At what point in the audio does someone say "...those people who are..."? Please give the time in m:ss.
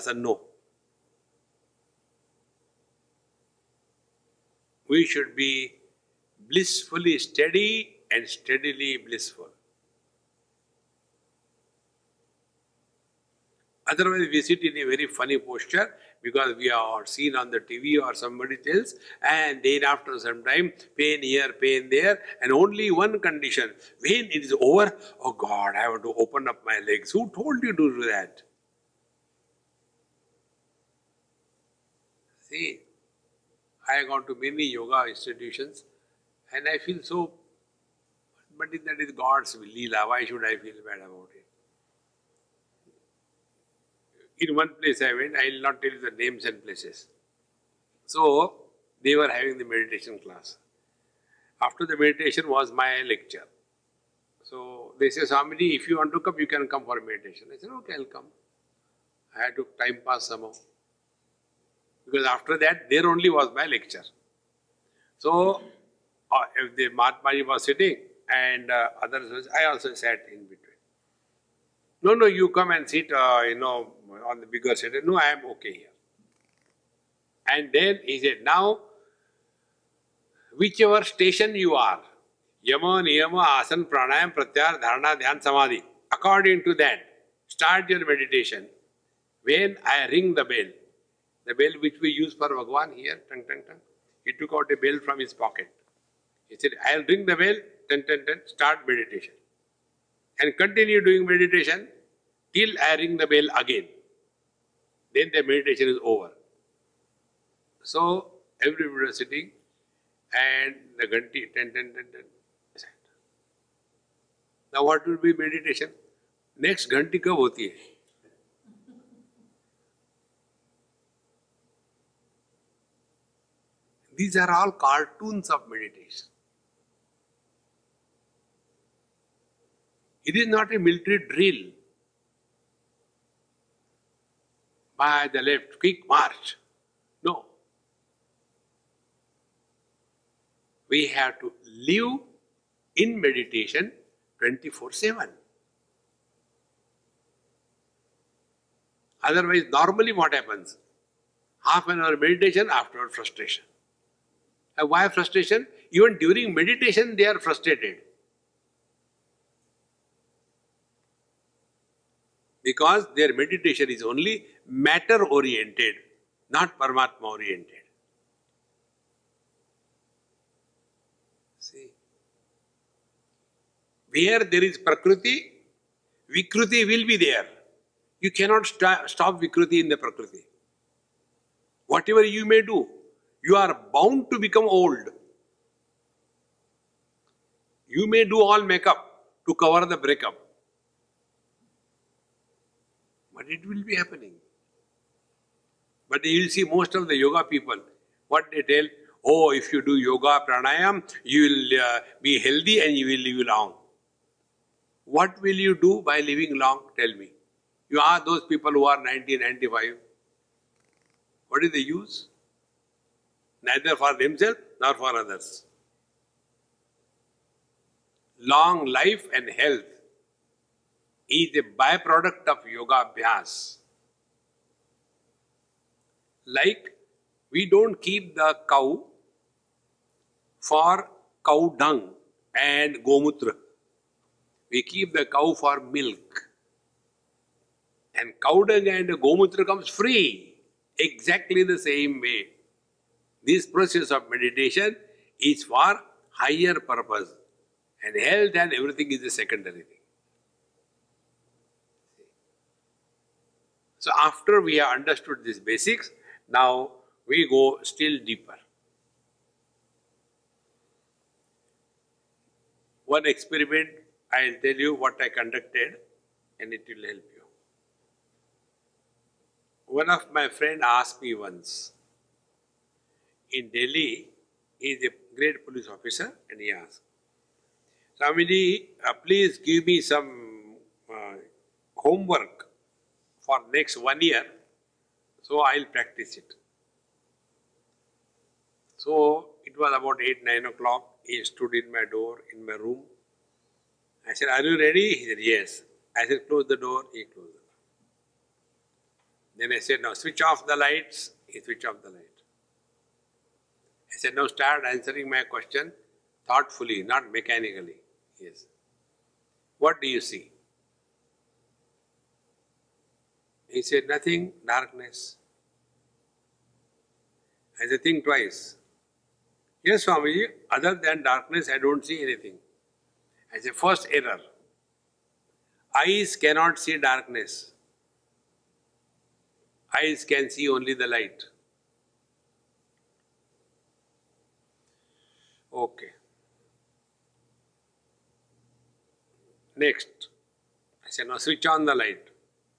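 3:28.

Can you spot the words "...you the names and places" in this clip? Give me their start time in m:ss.
0:45.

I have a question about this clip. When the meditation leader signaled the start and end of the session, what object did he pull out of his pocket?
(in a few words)
a bell.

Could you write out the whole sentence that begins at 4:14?
So after we have understood these basics, now we go still deeper.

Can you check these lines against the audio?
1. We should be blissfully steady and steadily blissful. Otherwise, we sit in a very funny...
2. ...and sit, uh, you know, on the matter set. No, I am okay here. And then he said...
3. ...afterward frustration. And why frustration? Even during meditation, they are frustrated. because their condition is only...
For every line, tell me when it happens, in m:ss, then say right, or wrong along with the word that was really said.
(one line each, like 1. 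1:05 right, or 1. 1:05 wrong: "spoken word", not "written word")
1. 0:04 right
2. 1:12 wrong: "bigger", not "matter"
3. 2:32 wrong: "meditation", not "condition".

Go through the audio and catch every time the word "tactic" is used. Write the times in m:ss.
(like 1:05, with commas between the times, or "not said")
not said.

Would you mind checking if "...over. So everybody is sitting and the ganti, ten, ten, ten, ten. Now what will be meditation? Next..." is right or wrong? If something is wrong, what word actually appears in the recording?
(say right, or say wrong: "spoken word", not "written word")
right.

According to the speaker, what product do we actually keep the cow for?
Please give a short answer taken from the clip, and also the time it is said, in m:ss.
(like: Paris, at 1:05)
milk, at 3:55.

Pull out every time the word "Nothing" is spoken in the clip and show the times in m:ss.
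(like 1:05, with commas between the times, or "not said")
5:14.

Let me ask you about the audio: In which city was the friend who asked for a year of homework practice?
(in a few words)
Delhi.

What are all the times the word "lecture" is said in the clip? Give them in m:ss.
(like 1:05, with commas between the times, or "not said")
0:53, 1:03.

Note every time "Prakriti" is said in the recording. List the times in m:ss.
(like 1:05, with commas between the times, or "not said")
2:54, 3:00.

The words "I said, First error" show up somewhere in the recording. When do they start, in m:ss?
5:23.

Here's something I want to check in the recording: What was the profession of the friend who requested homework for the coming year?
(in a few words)
police officer.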